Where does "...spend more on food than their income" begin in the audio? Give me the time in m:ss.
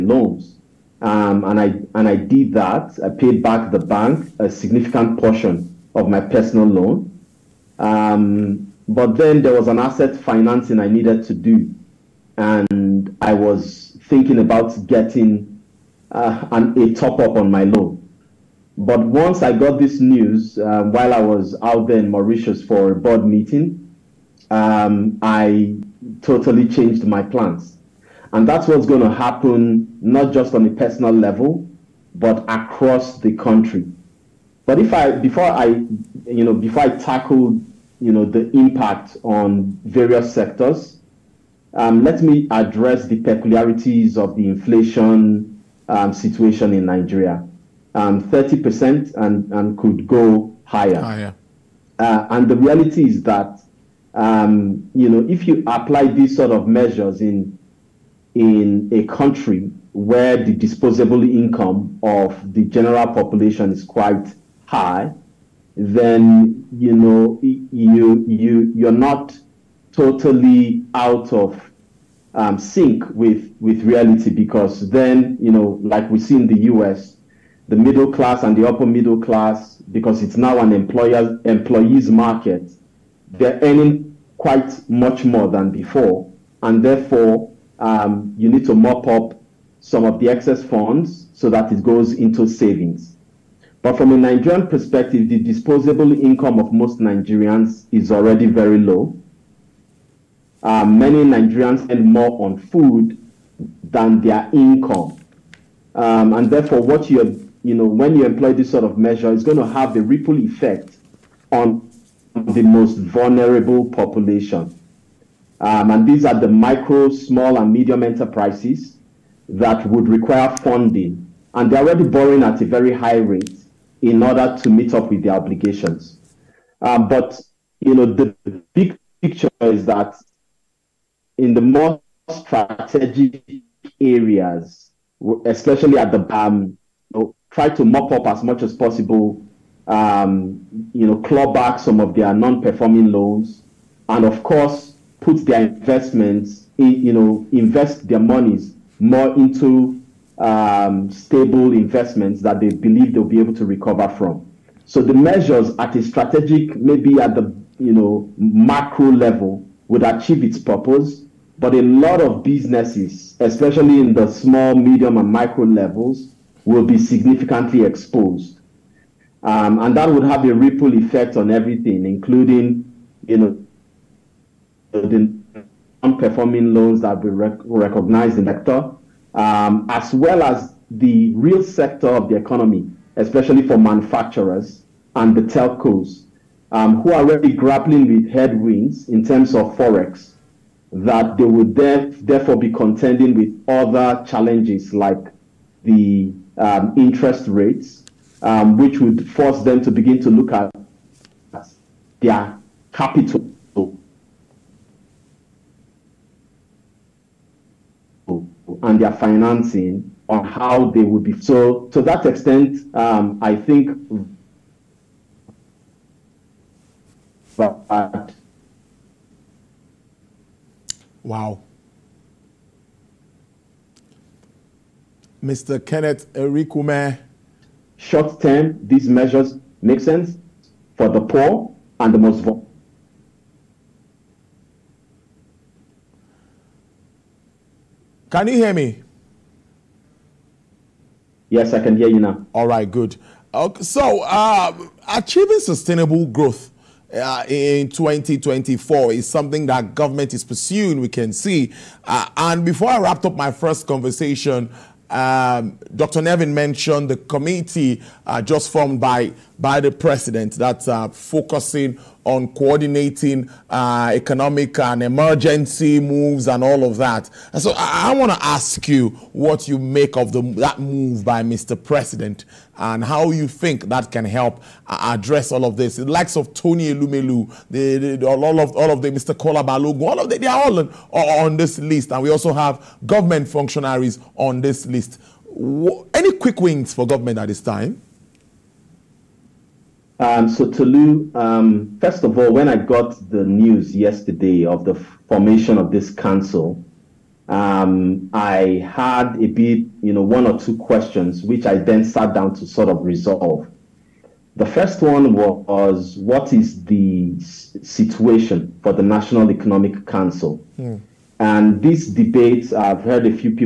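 1:41.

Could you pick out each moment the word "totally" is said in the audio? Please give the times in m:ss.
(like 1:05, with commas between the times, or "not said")
0:26, 1:09.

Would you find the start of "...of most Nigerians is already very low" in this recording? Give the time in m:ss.
1:36.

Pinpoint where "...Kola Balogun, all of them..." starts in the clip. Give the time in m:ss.
4:39.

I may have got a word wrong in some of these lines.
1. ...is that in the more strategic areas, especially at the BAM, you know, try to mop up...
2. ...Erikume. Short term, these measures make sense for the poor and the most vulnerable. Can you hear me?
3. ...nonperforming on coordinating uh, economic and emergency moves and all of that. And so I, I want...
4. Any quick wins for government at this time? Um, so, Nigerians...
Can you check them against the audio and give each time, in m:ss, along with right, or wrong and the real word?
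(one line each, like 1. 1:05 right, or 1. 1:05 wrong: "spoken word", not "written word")
1. 2:09 right
2. 3:46 right
3. 4:21 wrong: "focusing", not "nonperforming"
4. 4:46 wrong: "Tolu", not "Nigerians".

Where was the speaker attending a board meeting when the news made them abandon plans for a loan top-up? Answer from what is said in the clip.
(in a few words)
Mauritius.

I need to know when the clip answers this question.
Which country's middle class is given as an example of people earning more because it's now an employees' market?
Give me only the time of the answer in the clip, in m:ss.
1:16.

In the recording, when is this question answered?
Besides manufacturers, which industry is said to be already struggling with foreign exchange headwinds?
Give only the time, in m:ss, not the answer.
3:05.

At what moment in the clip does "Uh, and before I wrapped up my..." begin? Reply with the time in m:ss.
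4:12.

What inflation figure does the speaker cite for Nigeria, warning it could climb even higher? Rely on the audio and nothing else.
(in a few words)
30%.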